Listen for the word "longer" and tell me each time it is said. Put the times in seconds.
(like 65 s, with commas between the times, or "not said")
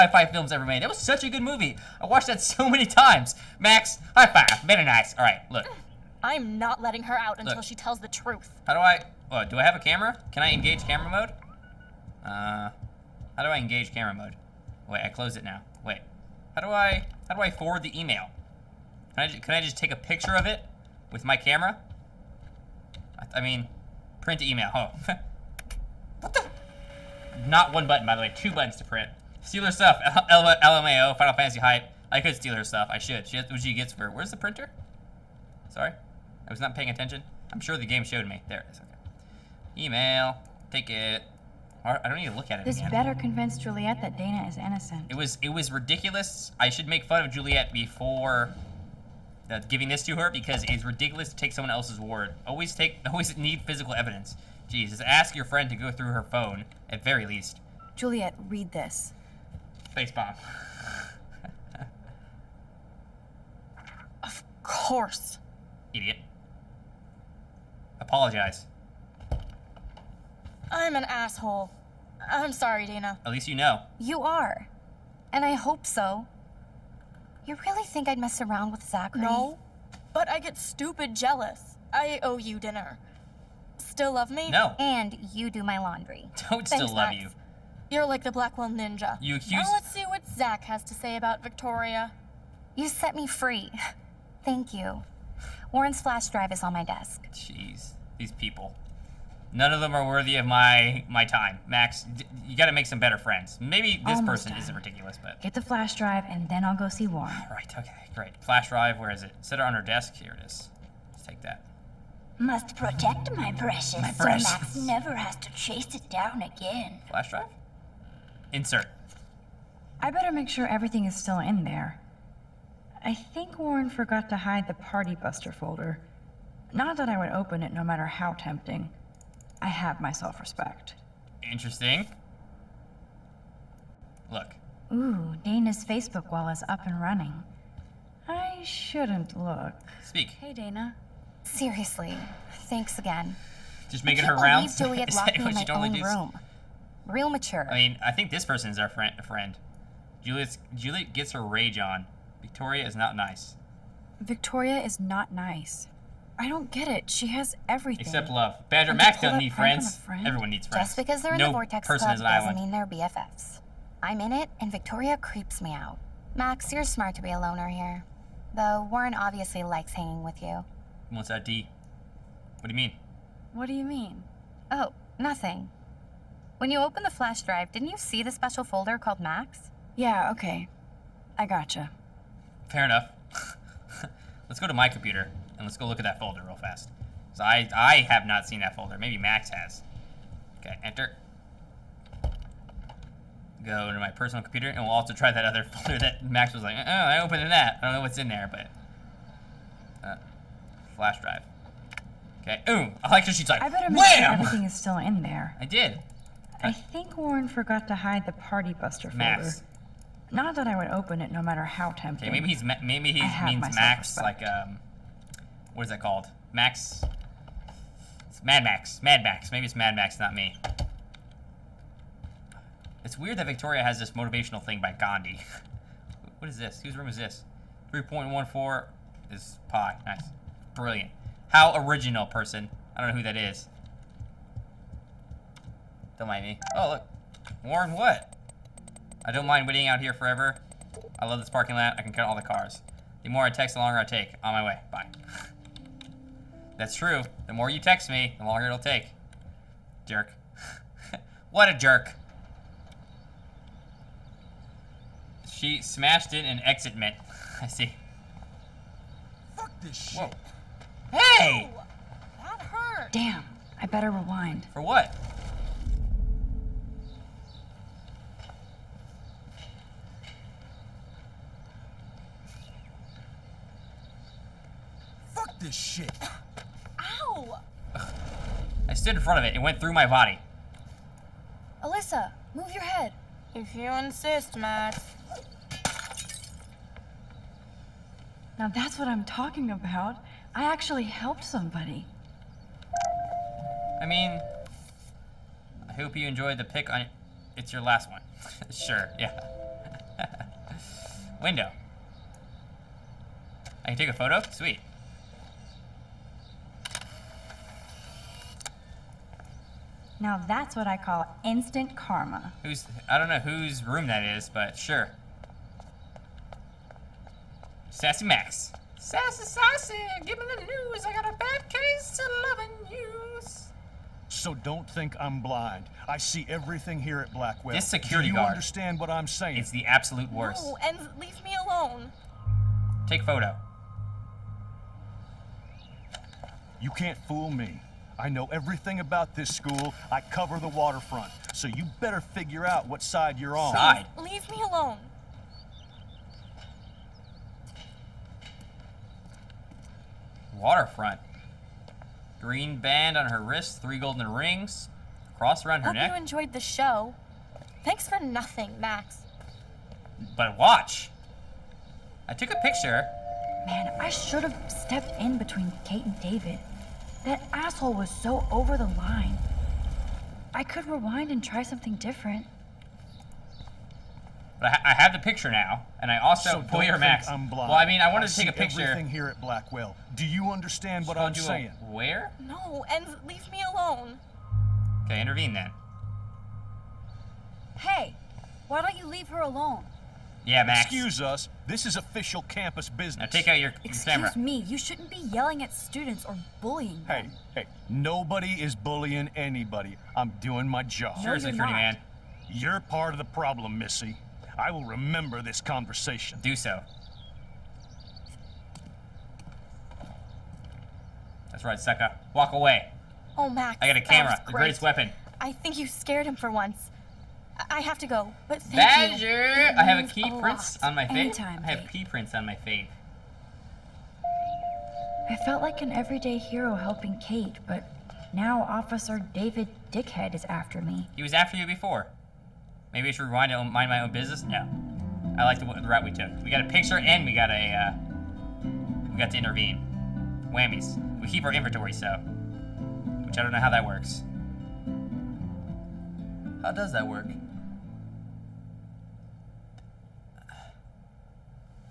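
243 s, 248 s.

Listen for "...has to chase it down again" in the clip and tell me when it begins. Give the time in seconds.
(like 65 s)
115 s.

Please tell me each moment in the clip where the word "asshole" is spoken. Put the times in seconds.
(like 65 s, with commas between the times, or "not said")
71 s, 367 s.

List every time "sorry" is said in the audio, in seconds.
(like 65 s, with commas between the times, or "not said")
35 s, 72 s.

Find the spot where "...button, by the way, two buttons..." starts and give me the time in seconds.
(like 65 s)
27 s.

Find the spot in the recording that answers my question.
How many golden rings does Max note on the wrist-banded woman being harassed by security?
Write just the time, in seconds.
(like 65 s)
353 s.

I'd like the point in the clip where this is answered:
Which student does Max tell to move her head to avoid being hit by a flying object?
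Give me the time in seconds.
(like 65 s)
281 s.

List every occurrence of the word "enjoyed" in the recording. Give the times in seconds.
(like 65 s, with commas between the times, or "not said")
296 s, 356 s.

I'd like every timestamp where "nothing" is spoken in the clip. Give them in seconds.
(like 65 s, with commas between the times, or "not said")
175 s, 358 s.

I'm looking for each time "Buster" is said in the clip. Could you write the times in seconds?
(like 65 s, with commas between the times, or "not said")
125 s, 208 s.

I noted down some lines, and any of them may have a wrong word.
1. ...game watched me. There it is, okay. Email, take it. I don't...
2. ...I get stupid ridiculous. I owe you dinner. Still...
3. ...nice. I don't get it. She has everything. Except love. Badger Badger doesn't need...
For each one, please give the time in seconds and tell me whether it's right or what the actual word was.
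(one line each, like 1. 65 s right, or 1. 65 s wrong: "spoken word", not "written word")
1. 37 s wrong: "showed", not "watched"
2. 80 s wrong: "jealous", not "ridiculous"
3. 155 s wrong: "Max", not "Badger".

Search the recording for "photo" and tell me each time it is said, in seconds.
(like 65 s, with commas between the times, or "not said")
304 s, 333 s.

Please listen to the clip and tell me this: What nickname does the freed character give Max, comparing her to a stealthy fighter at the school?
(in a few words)
Blackwell Ninja.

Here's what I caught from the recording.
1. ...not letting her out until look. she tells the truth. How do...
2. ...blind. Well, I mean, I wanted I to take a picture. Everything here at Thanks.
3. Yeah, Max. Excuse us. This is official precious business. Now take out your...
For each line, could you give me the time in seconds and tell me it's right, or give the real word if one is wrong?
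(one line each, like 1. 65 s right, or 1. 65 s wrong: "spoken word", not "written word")
1. 6 s right
2. 377 s wrong: "Blackwell", not "Thanks"
3. 390 s wrong: "campus", not "precious".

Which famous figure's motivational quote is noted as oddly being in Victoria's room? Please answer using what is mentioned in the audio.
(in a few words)
Gandhi.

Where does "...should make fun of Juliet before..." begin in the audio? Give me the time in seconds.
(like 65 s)
46 s.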